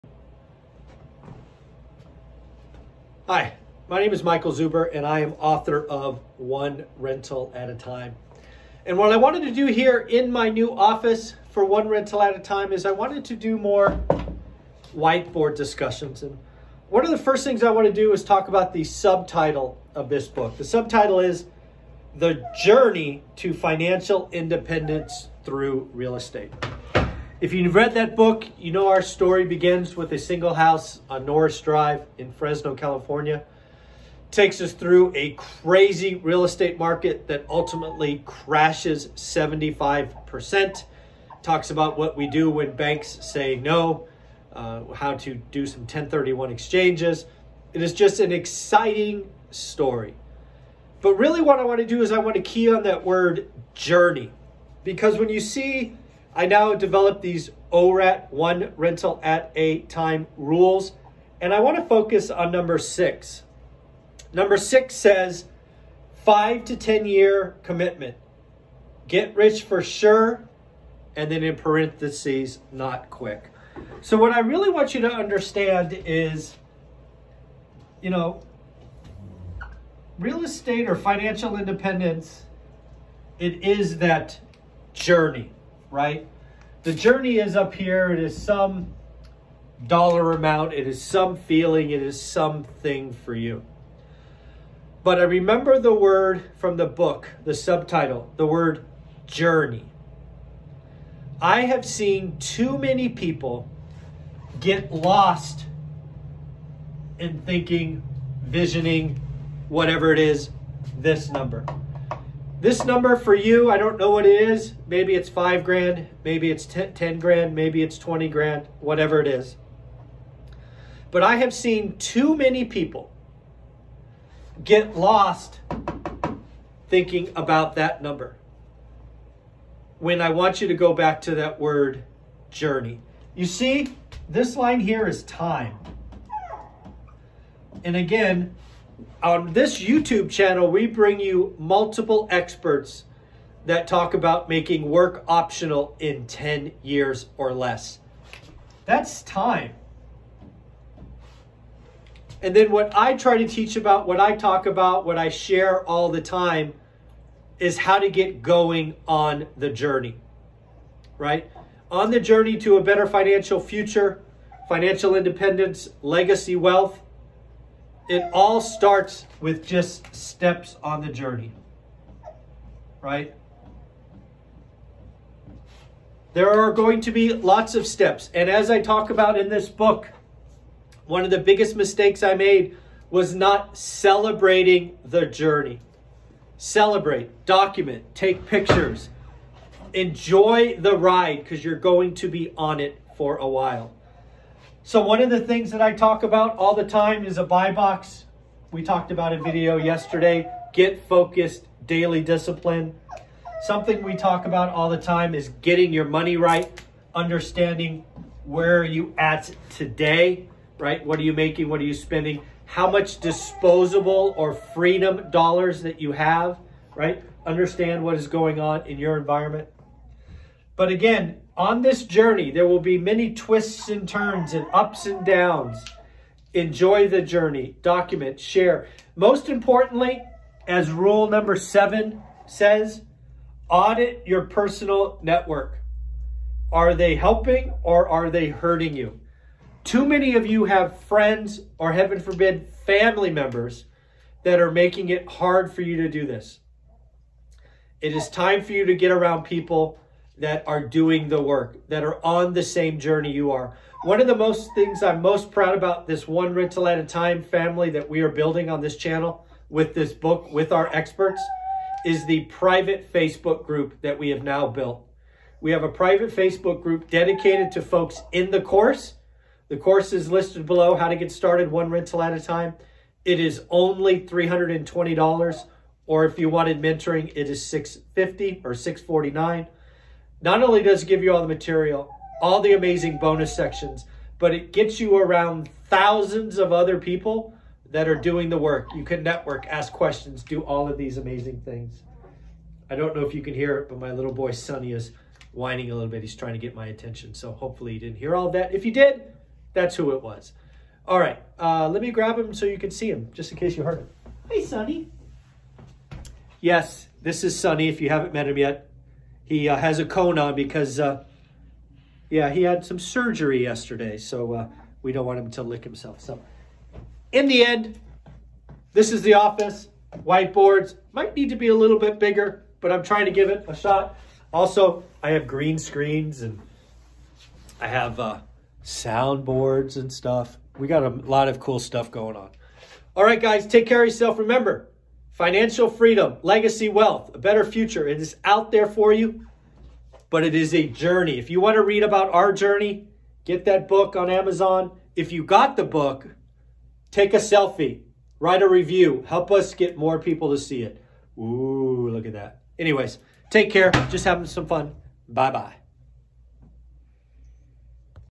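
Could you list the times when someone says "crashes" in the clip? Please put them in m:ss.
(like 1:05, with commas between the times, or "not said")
0:38.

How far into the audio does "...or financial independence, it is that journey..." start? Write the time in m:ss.
1:20.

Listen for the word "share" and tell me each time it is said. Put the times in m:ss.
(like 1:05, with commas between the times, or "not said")
2:35, 3:48.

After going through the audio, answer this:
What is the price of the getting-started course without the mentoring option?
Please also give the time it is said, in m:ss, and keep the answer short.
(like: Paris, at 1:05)
$320, at 4:34.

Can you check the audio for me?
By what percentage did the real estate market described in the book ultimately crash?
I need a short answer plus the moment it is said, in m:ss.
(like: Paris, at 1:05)
75%, at 0:39.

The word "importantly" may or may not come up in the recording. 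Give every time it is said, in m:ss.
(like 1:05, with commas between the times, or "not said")
3:49.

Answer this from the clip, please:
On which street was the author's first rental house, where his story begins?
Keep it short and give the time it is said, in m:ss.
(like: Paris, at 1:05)
Norris Drive, at 0:31.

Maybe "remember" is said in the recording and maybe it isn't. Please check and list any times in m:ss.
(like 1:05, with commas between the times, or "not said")
1:35, 5:34.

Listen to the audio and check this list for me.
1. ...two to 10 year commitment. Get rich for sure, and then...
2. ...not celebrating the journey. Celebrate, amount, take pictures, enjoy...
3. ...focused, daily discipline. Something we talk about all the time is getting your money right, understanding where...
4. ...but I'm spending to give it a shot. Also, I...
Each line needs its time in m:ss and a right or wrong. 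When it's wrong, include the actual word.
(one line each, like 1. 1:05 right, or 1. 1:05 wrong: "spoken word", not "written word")
1. 1:06 wrong: "five", not "two"
2. 3:03 wrong: "document", not "amount"
3. 3:21 right
4. 5:22 wrong: "trying", not "spending".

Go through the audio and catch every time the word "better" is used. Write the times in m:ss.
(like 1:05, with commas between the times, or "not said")
2:42, 5:37.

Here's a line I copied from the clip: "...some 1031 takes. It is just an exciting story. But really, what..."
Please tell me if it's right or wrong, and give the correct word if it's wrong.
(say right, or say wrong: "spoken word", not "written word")
wrong: "exchanges", not "takes".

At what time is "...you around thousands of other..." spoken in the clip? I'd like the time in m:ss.
4:44.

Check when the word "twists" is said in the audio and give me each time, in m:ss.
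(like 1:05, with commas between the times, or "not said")
3:43.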